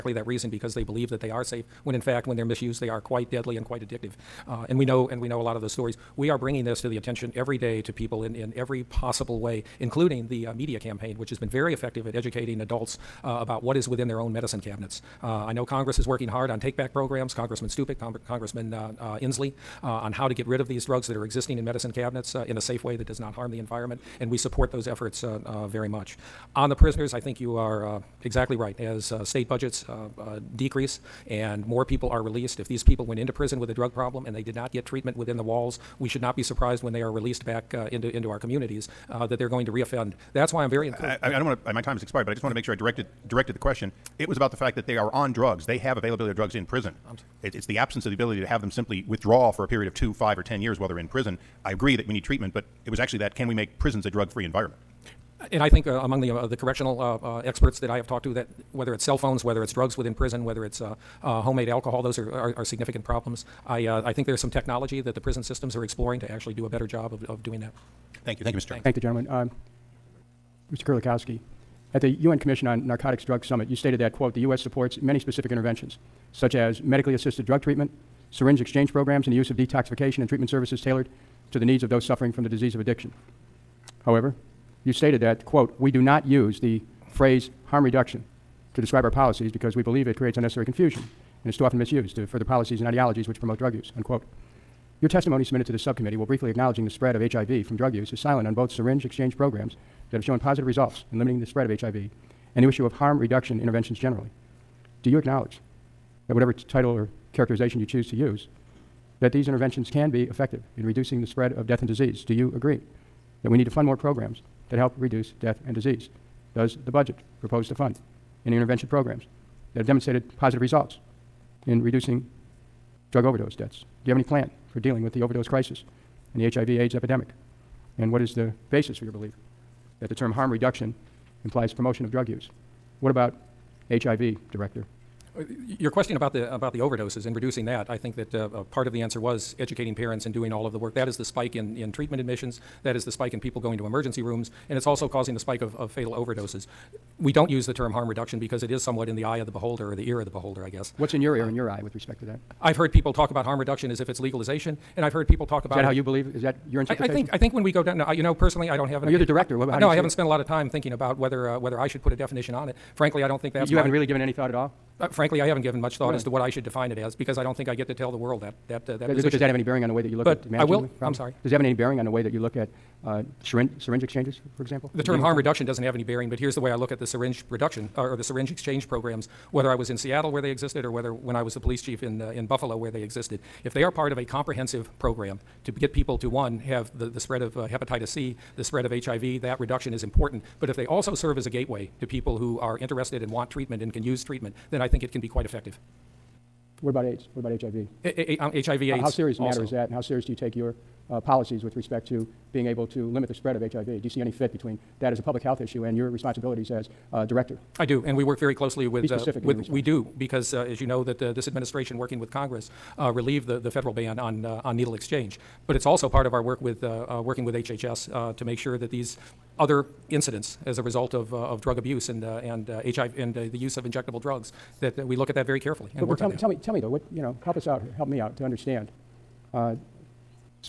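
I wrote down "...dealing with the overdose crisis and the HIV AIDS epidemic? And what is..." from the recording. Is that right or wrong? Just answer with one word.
right.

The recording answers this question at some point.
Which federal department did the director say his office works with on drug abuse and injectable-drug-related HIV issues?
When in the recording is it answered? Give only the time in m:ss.
3:37.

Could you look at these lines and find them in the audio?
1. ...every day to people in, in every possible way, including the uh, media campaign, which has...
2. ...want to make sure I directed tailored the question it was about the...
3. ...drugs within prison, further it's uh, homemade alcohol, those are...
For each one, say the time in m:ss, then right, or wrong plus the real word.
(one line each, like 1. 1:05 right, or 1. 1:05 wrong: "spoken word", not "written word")
1. 0:07 right
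2. 0:42 wrong: "directed", not "tailored"
3. 0:59 wrong: "whether", not "further".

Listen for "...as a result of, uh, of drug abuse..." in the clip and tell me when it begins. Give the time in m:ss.
3:40.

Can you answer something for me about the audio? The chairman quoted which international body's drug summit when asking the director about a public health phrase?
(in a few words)
UN Commission on Narcotics.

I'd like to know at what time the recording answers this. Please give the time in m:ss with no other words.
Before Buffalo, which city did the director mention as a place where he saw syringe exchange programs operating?
2:59.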